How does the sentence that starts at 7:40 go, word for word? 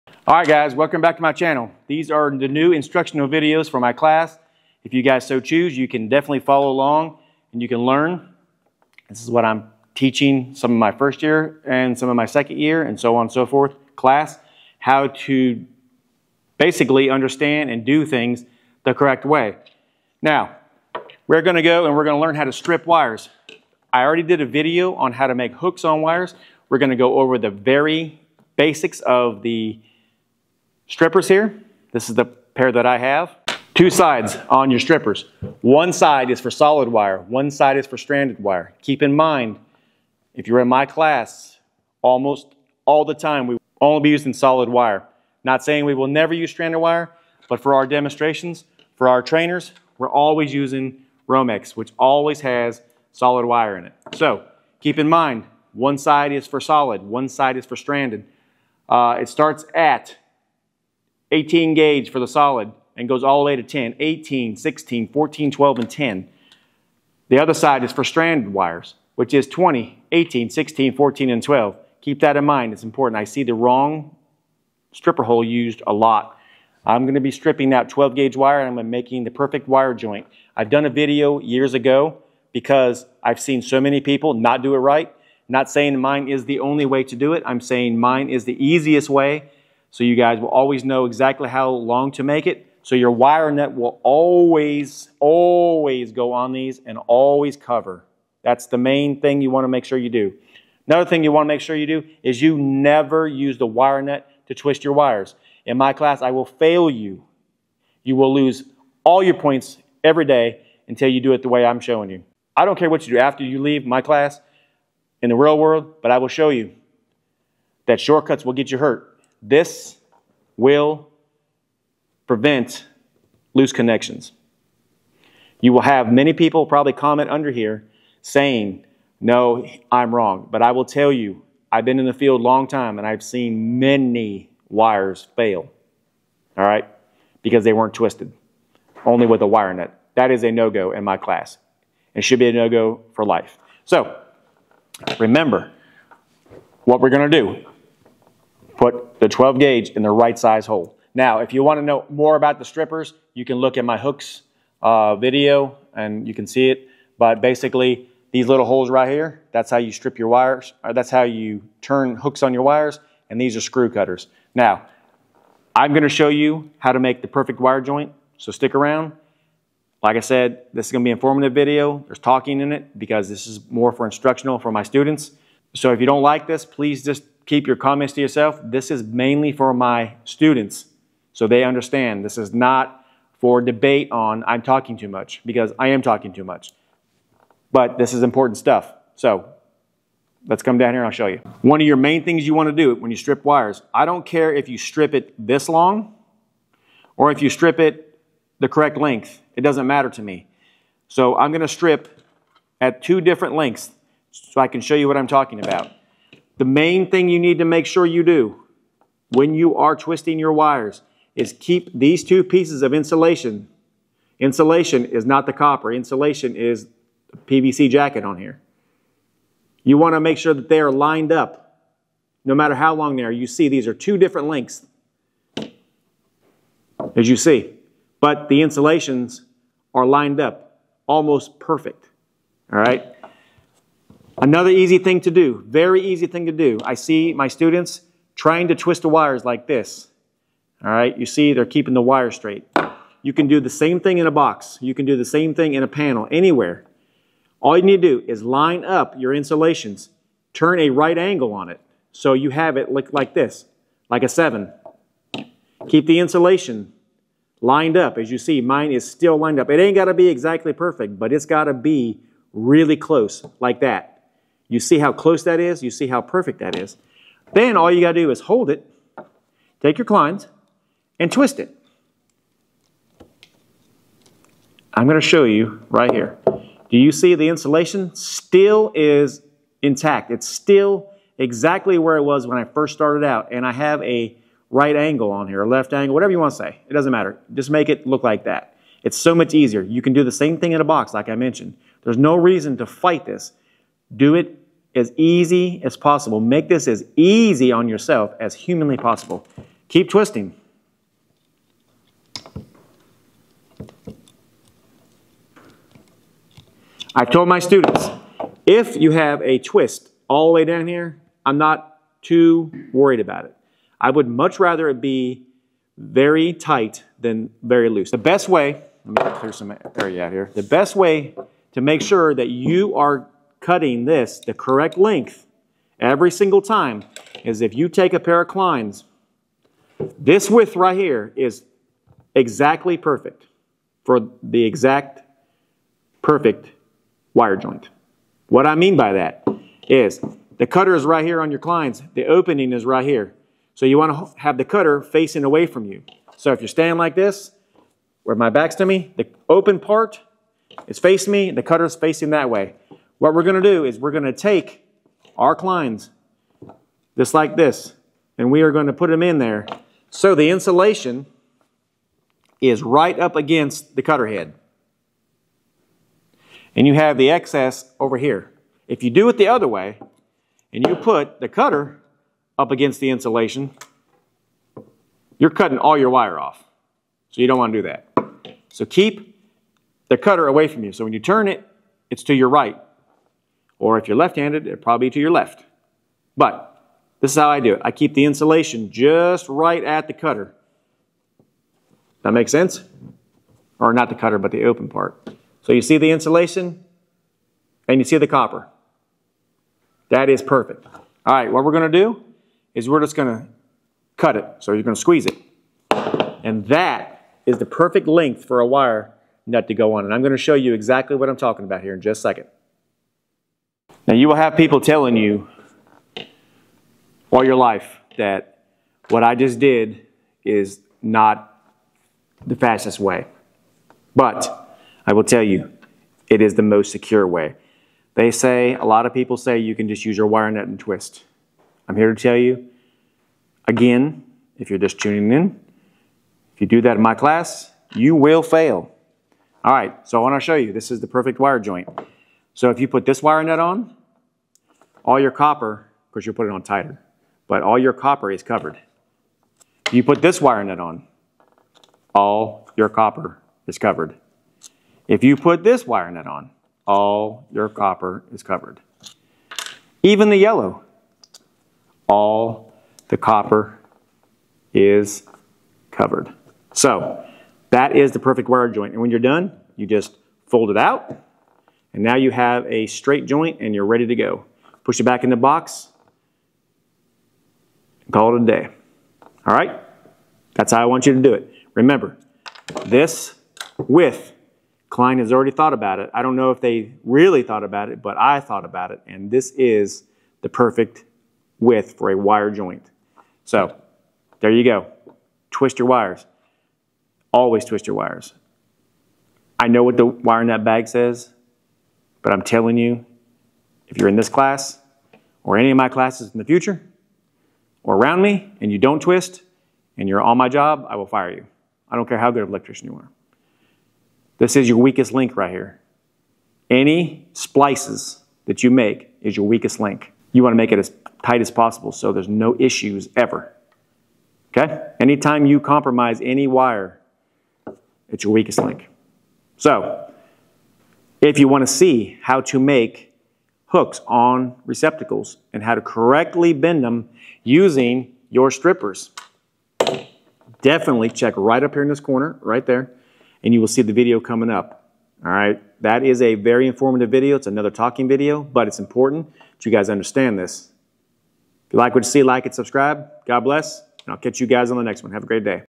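Even the yellow, all the copper is covered.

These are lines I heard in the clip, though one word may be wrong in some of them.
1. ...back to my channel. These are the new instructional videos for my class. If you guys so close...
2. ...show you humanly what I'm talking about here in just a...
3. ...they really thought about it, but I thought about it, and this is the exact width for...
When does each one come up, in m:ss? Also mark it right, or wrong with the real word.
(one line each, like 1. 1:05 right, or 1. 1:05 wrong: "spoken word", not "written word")
1. 0:01 wrong: "choose", not "close"
2. 6:50 wrong: "exactly", not "humanly"
3. 8:06 wrong: "perfect", not "exact".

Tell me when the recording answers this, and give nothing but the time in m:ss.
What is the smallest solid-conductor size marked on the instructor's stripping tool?
1:01.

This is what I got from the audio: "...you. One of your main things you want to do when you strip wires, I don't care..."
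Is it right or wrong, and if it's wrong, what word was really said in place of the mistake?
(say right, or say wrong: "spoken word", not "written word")
right.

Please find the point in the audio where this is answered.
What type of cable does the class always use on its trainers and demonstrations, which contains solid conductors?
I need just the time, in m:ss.
0:51.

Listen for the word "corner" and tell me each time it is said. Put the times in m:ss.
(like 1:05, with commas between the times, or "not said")
9:02.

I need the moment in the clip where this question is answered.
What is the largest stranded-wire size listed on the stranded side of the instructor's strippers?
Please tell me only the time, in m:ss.
1:10.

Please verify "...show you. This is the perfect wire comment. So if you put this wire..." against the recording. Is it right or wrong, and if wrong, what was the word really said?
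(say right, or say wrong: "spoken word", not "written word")
wrong: "joint", not "comment".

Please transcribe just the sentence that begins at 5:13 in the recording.
I would much rather it be very tight than very loose.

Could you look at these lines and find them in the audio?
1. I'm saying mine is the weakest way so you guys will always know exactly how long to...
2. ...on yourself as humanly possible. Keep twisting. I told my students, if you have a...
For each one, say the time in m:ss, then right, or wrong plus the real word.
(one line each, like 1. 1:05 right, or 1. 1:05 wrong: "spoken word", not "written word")
1. 1:27 wrong: "easiest", not "weakest"
2. 4:57 right.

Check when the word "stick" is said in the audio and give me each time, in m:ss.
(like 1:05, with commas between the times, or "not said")
2:48.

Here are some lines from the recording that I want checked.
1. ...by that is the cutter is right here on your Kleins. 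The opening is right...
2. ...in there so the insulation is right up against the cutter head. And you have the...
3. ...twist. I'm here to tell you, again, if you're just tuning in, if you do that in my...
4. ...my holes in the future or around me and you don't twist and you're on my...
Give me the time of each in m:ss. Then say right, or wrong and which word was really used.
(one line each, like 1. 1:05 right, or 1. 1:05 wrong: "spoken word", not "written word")
1. 5:38 right
2. 5:59 right
3. 7:10 right
4. 8:25 wrong: "classes", not "holes".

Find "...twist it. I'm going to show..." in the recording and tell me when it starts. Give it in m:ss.
4:31.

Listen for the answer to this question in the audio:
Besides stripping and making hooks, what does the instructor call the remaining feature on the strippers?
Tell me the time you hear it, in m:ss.
2:43.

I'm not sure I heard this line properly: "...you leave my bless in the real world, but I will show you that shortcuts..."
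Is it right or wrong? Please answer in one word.
wrong.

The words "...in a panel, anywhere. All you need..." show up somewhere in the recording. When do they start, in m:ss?
4:05.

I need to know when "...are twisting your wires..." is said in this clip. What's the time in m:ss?
3:29.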